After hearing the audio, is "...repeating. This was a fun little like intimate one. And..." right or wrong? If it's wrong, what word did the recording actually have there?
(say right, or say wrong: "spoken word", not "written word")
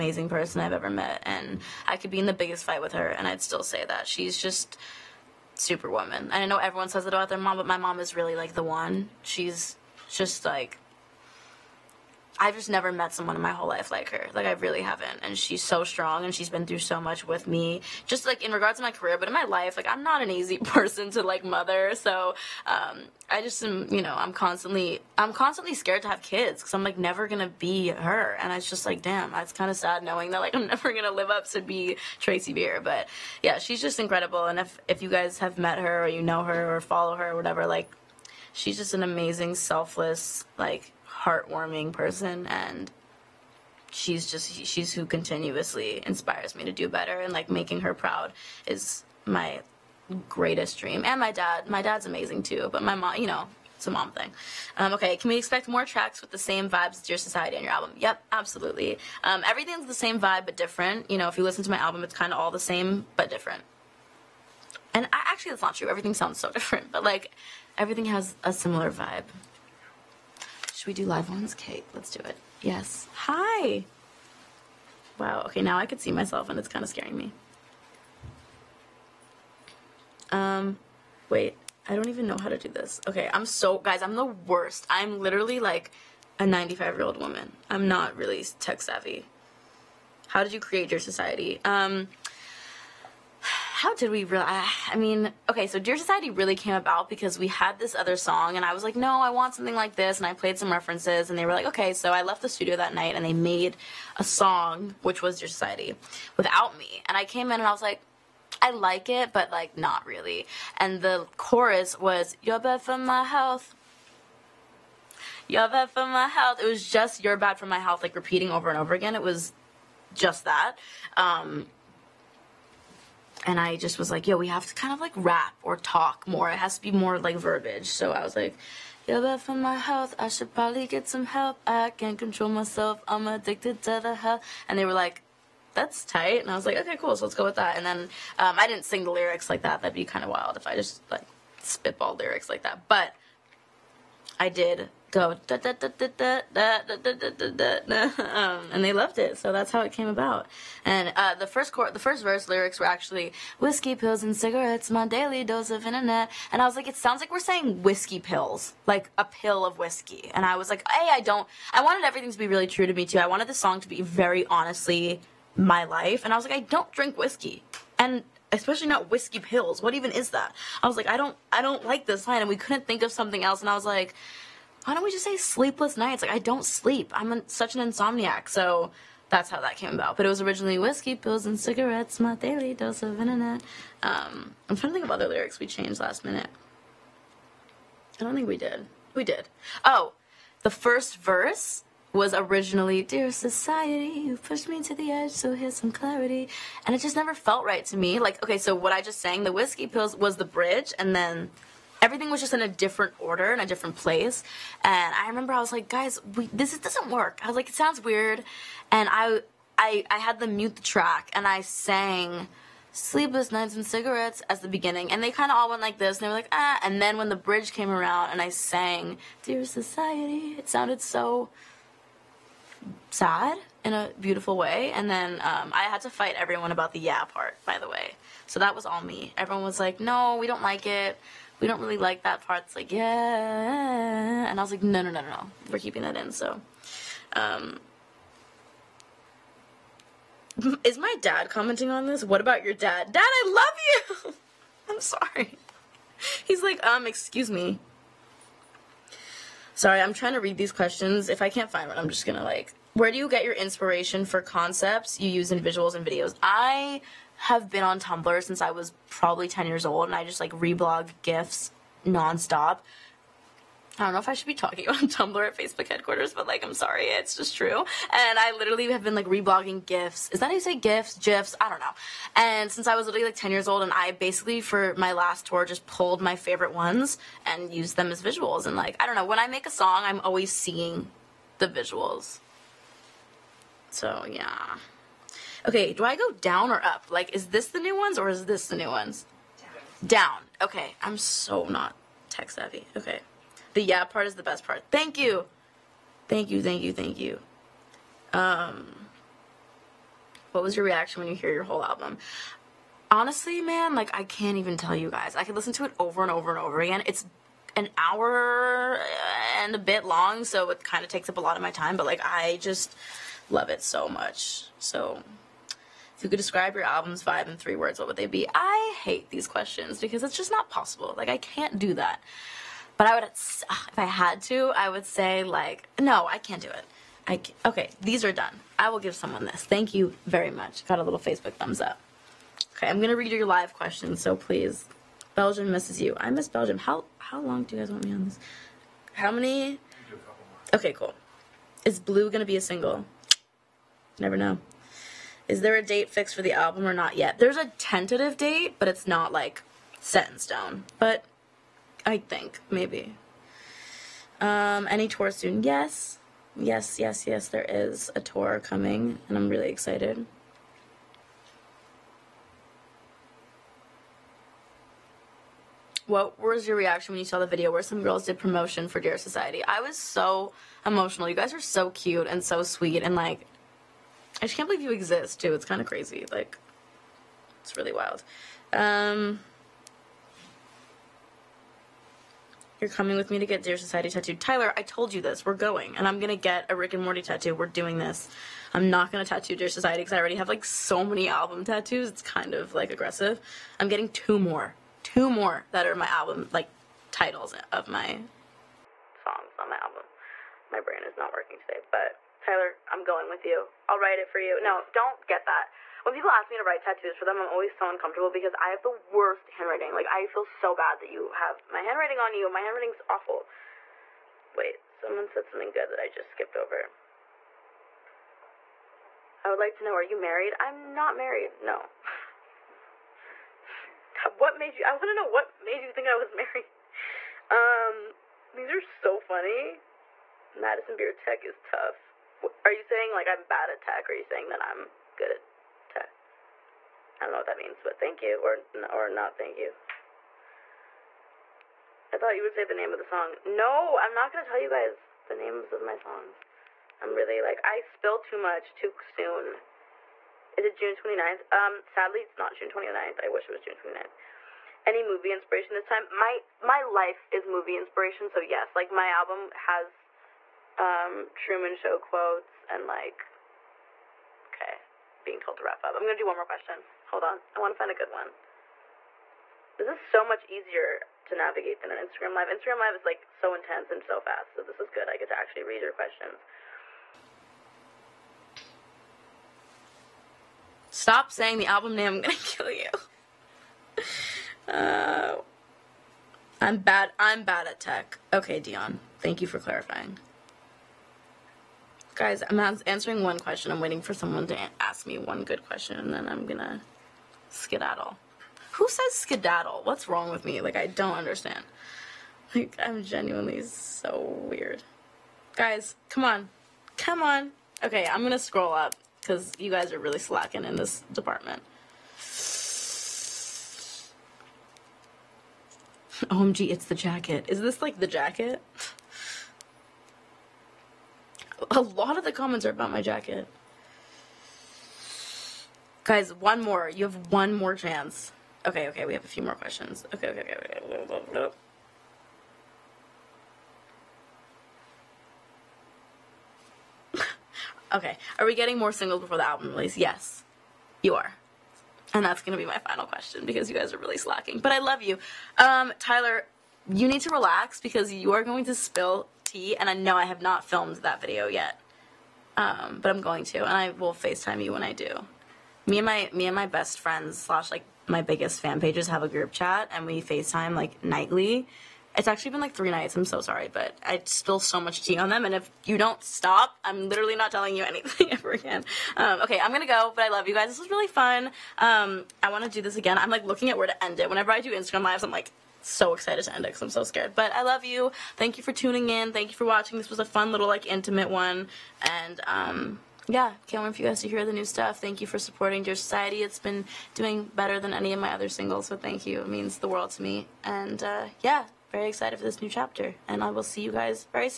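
wrong: "watching", not "repeating".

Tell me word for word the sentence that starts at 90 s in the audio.
How did you create your society?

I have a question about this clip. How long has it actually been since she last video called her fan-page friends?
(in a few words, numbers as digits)
3 nights.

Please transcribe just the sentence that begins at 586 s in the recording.
It's been doing better than any of my other singles, so thank you.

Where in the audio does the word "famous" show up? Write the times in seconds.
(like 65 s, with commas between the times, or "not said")
not said.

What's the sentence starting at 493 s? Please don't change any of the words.
I'm waiting for someone to ask me one good question, and then I'm gonna skedaddle.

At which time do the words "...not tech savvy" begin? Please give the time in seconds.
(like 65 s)
291 s.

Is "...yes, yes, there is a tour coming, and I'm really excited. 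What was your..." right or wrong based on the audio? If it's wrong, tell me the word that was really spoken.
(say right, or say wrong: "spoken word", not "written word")
right.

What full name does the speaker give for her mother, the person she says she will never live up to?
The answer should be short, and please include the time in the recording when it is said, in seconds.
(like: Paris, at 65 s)
Tracy Beer, at 32 s.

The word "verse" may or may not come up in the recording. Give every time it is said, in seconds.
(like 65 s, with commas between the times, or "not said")
152 s, 191 s.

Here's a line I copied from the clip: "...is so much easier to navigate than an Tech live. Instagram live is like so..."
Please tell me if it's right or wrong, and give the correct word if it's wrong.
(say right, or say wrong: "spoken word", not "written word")
wrong: "Instagram", not "Tech".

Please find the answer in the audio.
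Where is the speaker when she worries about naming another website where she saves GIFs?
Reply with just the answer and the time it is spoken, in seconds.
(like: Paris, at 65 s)
Facebook headquarters, at 265 s.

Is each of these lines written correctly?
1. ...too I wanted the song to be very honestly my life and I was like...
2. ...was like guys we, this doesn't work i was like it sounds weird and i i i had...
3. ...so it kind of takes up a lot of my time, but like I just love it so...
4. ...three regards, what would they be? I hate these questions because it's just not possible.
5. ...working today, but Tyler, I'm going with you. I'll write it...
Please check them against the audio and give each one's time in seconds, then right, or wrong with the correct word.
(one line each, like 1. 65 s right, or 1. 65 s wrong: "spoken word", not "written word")
1. 163 s right
2. 205 s right
3. 310 s right
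4. 317 s wrong: "words", not "regards"
5. 401 s right.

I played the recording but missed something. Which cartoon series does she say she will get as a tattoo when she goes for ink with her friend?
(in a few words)
Rick and Morty.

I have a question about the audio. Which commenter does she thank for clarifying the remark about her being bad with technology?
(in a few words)
Dion.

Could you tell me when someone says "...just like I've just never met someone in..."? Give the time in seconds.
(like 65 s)
10 s.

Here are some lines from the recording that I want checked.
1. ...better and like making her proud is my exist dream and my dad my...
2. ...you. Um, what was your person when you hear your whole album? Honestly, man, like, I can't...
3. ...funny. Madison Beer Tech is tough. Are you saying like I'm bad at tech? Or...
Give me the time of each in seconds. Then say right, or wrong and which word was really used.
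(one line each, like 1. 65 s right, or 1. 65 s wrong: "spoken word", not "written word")
1. 46 s wrong: "greatest", not "exist"
2. 297 s wrong: "reaction", not "person"
3. 429 s right.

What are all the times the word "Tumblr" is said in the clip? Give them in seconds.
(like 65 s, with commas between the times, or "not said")
257 s, 265 s.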